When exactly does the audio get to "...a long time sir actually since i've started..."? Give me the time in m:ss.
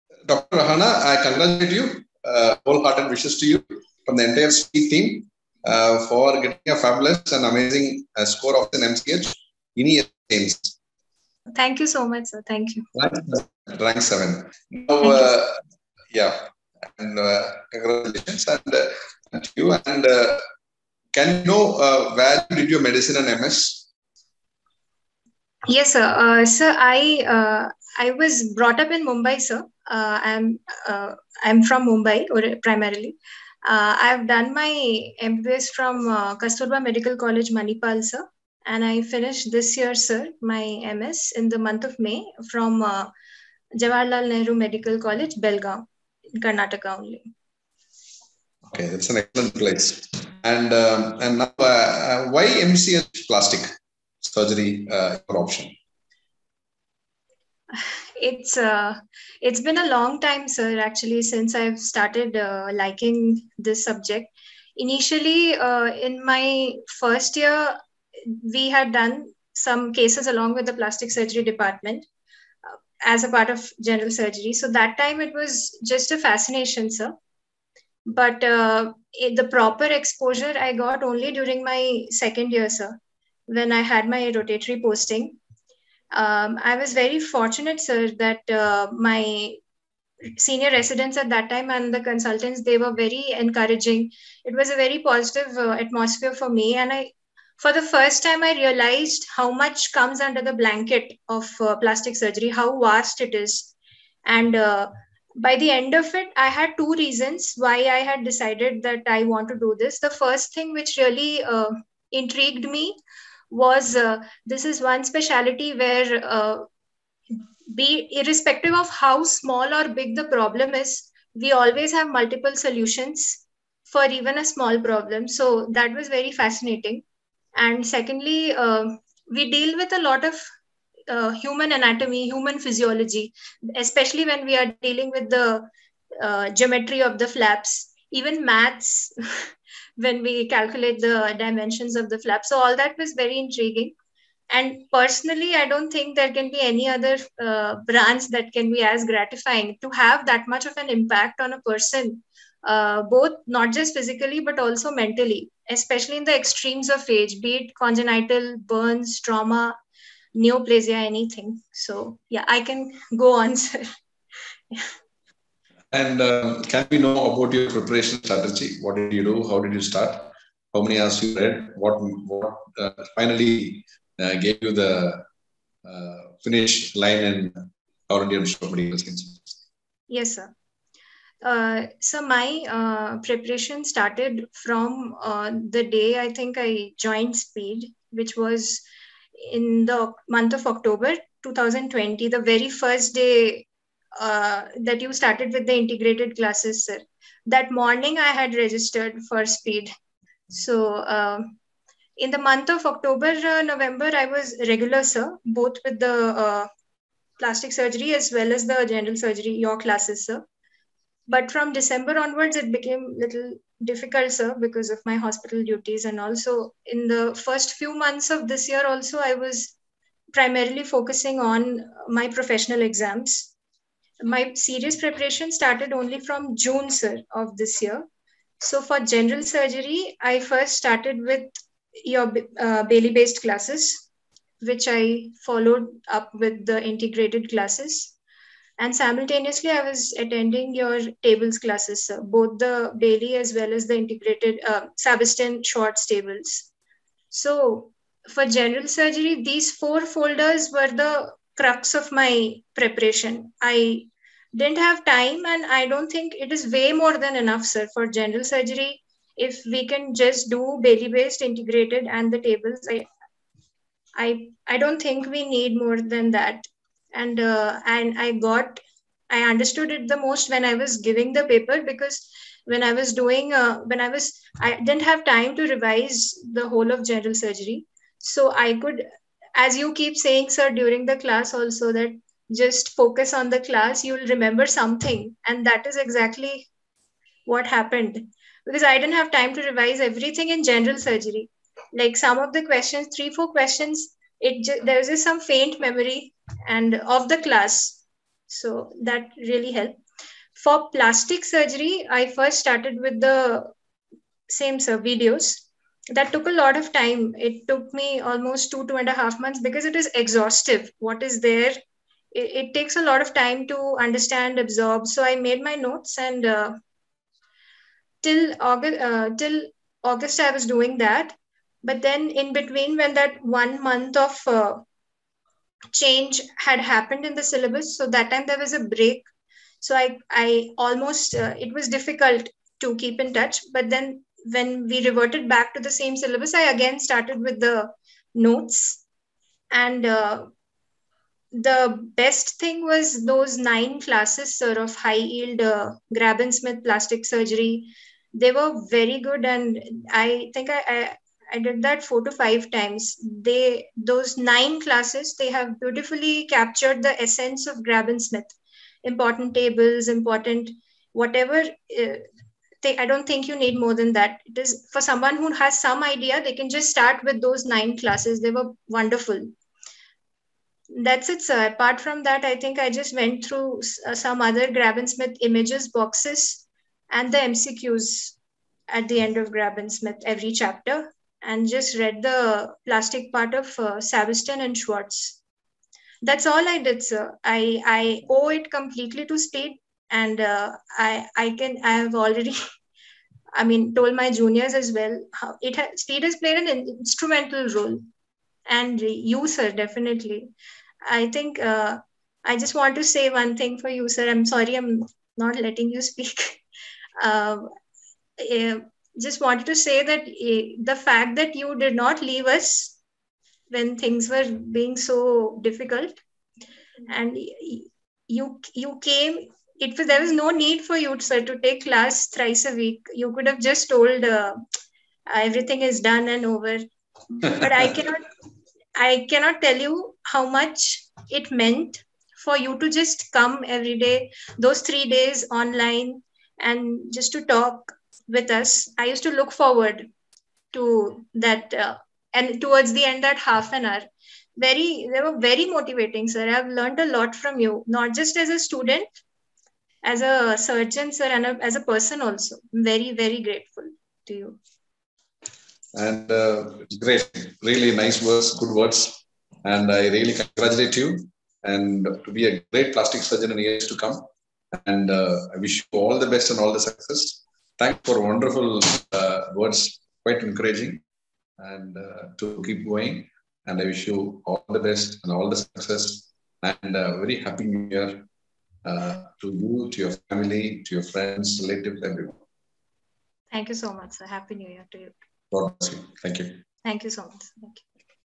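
0:59.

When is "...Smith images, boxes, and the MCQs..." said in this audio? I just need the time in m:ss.
6:15.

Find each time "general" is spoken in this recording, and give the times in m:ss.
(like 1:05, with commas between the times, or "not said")
1:13, 3:28, 3:48, 4:08, 4:18, 4:37, 4:50.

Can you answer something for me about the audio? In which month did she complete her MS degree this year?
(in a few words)
May.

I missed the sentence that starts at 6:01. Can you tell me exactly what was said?
Uh, they, I don't think you need more than that.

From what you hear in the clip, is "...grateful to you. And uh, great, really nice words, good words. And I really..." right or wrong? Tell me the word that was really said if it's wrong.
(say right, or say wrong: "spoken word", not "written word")
right.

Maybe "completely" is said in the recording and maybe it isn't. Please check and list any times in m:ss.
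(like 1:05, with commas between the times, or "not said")
6:28.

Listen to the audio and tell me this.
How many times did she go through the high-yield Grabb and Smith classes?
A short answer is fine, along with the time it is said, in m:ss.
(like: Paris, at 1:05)
4 to 5, at 5:52.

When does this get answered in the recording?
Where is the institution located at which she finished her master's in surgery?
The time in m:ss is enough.
0:45.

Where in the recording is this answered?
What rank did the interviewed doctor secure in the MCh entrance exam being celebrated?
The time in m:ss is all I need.
0:13.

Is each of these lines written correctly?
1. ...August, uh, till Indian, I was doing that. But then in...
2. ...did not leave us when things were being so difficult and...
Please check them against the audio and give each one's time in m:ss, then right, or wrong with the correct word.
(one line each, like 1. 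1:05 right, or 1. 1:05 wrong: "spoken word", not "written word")
1. 5:18 wrong: "August", not "Indian"
2. 6:51 right.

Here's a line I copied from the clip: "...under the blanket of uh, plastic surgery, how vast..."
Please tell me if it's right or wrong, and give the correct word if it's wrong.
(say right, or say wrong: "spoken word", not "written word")
right.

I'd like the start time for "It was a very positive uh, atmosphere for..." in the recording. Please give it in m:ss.
1:34.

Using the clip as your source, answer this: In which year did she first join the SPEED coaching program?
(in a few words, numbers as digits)
2020.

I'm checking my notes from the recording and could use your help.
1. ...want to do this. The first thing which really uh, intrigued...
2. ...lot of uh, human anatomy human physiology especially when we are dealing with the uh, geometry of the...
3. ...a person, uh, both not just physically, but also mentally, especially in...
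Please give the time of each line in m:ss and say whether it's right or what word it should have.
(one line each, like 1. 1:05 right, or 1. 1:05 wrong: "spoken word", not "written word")
1. 1:49 right
2. 2:10 right
3. 2:31 right.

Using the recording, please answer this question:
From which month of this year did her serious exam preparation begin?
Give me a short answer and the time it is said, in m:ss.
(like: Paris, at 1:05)
June, at 3:46.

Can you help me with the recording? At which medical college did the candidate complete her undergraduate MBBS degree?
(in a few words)
Kasturba Medical College, Manipal.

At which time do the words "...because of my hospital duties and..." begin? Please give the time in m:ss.
3:34.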